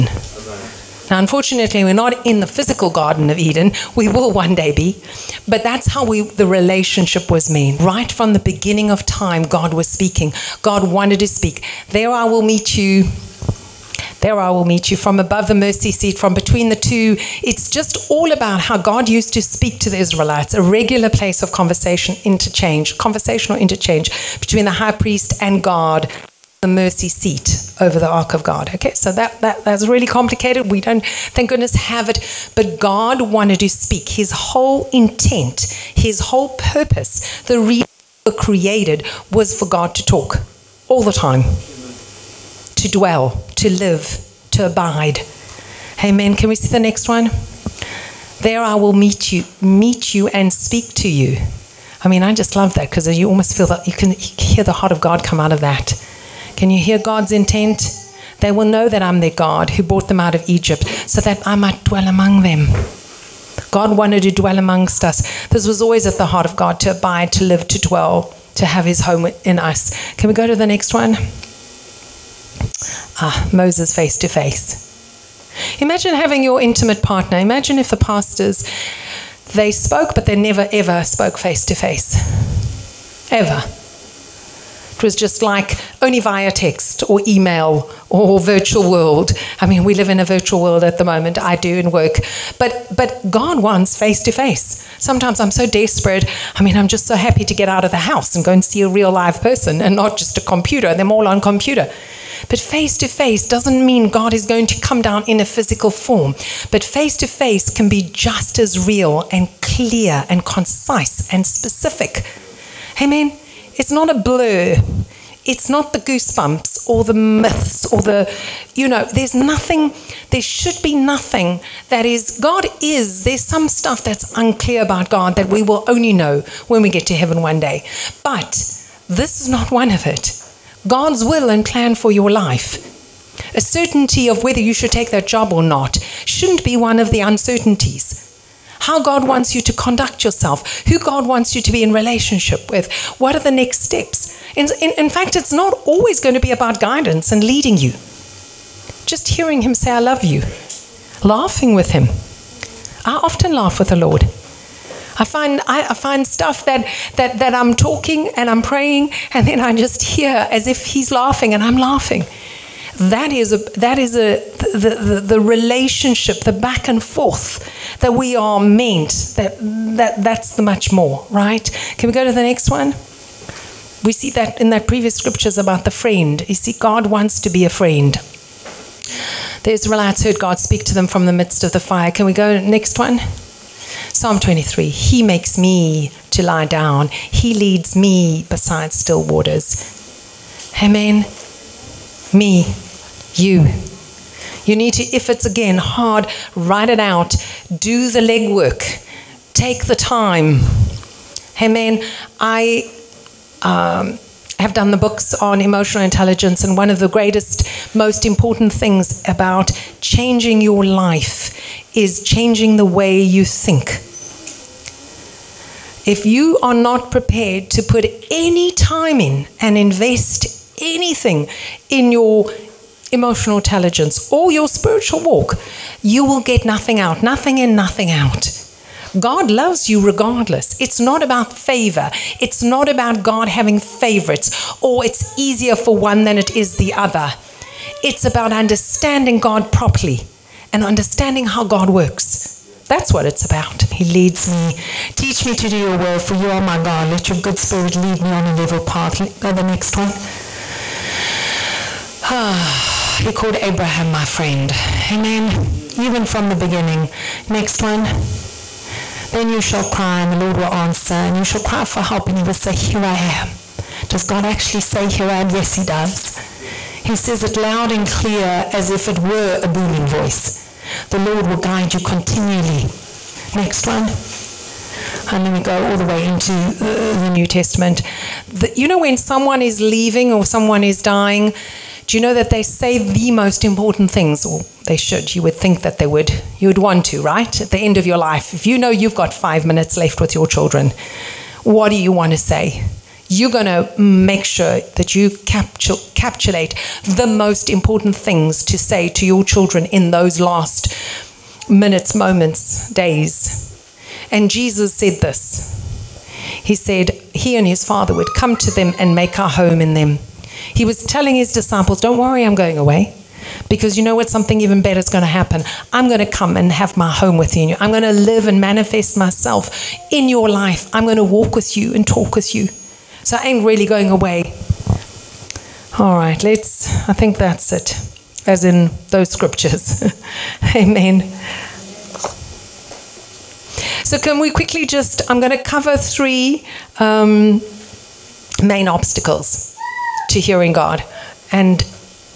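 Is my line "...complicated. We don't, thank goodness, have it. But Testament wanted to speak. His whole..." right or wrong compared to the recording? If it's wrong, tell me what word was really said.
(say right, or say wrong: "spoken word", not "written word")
wrong: "God", not "Testament".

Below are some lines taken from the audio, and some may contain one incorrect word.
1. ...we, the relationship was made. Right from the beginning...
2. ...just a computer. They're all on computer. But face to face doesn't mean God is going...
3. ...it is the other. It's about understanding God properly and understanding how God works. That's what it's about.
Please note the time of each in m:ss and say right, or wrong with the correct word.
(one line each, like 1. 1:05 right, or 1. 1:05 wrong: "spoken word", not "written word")
1. 0:06 right
2. 1:40 right
3. 3:56 right.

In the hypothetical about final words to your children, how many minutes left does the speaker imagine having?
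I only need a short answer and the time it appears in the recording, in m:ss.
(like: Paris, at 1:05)
5, at 4:49.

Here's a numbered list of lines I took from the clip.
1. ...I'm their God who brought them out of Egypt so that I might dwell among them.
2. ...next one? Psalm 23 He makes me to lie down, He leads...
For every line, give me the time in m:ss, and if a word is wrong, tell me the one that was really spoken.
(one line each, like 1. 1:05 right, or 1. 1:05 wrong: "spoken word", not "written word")
1. 0:59 right
2. 3:02 right.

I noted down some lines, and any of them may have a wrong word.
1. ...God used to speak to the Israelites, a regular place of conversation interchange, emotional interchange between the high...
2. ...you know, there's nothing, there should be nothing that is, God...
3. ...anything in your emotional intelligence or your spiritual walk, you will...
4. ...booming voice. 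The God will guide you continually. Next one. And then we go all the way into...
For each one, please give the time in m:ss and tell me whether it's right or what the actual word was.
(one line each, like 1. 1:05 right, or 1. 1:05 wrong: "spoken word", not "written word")
1. 0:18 wrong: "conversational", not "emotional"
2. 1:58 right
3. 3:40 right
4. 4:29 wrong: "Lord", not "God".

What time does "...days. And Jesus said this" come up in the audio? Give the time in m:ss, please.
5:02.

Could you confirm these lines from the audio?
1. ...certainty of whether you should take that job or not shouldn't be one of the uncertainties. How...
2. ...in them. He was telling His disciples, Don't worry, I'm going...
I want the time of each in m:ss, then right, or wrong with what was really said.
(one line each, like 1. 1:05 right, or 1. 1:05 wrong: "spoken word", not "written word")
1. 2:13 right
2. 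5:09 right.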